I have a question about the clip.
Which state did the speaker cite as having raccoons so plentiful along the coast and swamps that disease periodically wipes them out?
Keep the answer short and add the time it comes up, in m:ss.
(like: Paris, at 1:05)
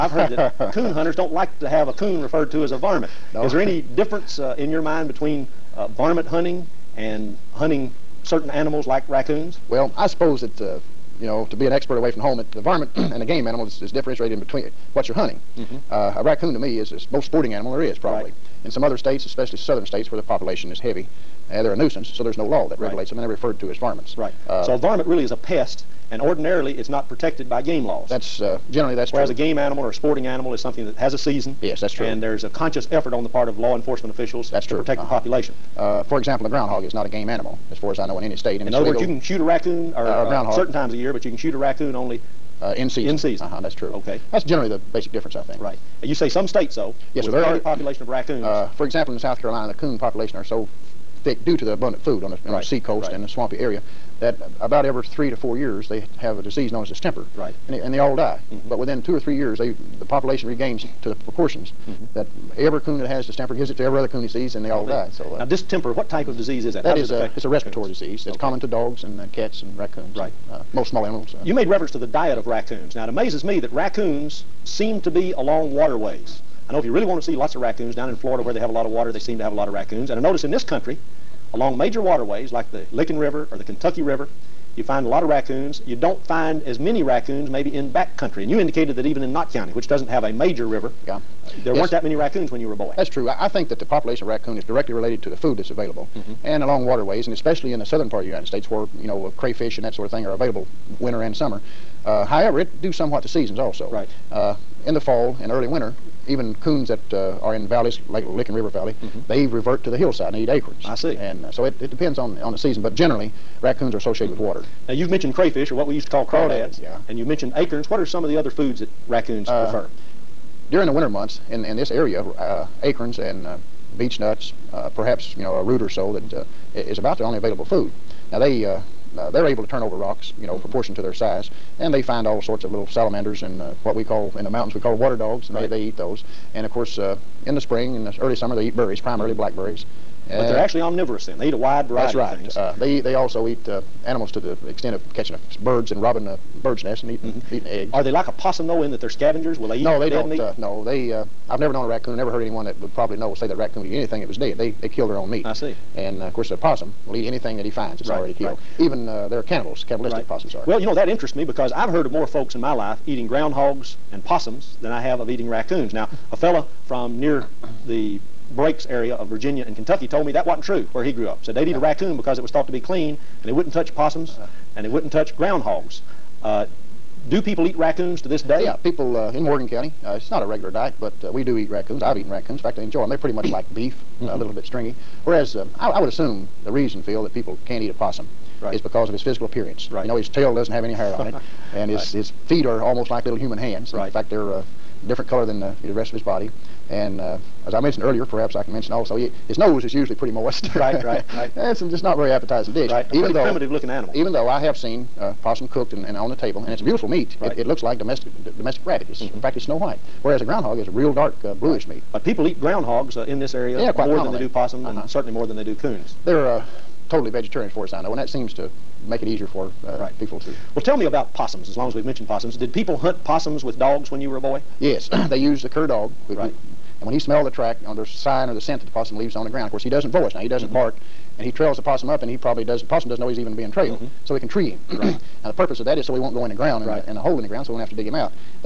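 South Carolina, at 0:49.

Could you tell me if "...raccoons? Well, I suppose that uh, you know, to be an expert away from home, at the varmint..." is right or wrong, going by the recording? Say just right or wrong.
right.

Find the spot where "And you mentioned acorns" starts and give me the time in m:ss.
1:57.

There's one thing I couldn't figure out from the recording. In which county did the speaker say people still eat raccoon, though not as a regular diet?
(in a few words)
Morgan County.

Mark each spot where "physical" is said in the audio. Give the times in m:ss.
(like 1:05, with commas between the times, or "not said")
3:09.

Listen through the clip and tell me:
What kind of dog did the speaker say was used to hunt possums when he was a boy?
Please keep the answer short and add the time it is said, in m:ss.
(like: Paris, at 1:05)
cur dog, at 3:45.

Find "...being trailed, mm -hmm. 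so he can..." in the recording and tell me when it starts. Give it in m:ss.
3:53.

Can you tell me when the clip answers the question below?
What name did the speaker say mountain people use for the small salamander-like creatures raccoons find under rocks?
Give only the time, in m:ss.
2:14.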